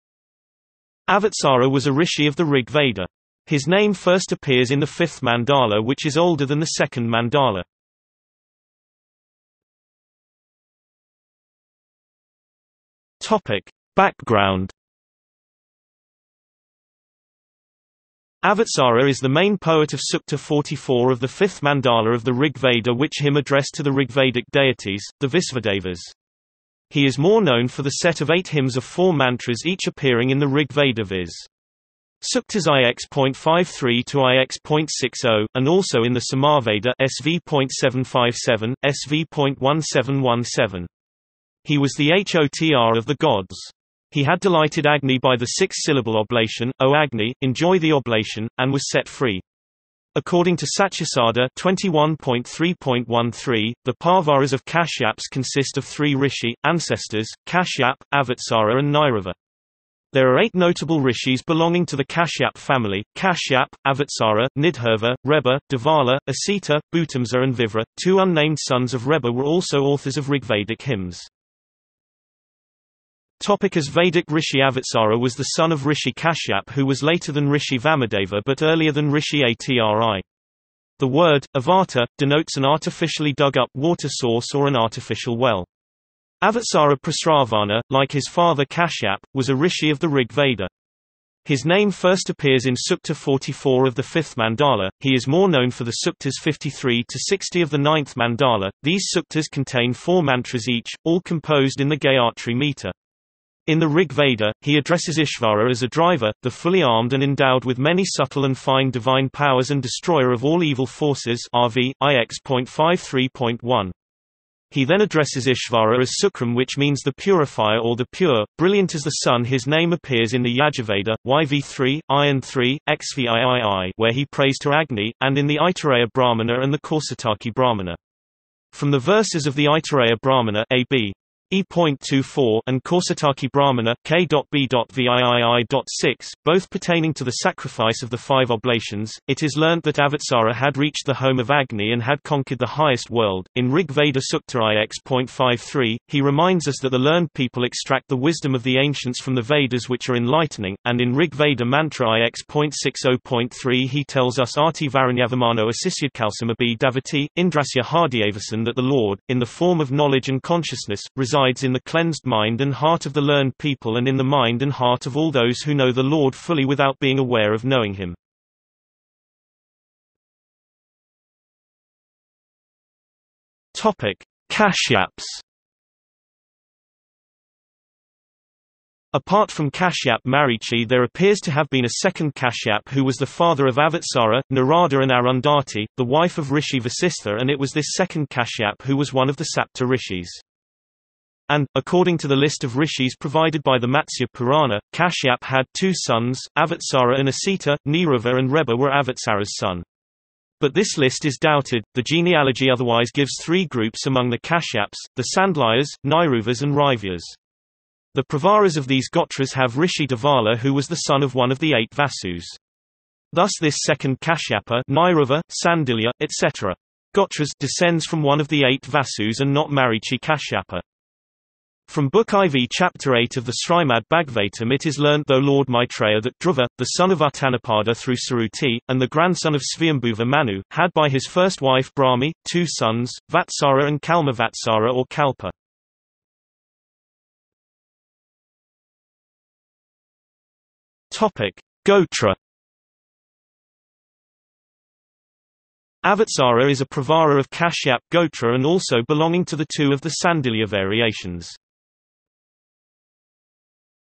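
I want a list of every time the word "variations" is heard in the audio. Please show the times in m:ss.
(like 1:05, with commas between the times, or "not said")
4:10.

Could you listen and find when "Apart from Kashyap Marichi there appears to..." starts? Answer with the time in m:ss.
2:59.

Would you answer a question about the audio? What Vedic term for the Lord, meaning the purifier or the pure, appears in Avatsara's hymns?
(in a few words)
Sukram.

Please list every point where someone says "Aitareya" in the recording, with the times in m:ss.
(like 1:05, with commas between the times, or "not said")
2:05, 2:09.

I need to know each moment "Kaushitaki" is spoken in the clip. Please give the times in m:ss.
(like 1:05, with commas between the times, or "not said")
2:06, 2:12.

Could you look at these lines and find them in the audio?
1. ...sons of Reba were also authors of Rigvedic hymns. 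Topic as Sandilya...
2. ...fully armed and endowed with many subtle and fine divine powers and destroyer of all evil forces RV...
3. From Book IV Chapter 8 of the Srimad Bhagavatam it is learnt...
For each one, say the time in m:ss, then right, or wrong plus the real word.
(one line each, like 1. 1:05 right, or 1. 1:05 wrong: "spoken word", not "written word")
1. 1:08 wrong: "Vedic", not "Sandilya"
2. 1:46 right
3. 3:41 right.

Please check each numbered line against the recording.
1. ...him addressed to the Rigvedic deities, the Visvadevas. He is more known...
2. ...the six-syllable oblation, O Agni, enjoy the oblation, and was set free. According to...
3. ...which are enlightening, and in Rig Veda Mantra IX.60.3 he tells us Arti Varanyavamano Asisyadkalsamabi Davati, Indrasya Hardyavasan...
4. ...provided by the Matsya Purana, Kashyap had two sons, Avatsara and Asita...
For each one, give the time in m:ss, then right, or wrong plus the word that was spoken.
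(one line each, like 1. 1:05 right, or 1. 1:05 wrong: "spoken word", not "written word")
1. 0:23 right
2. 0:45 right
3. 2:29 right
4. 3:13 right.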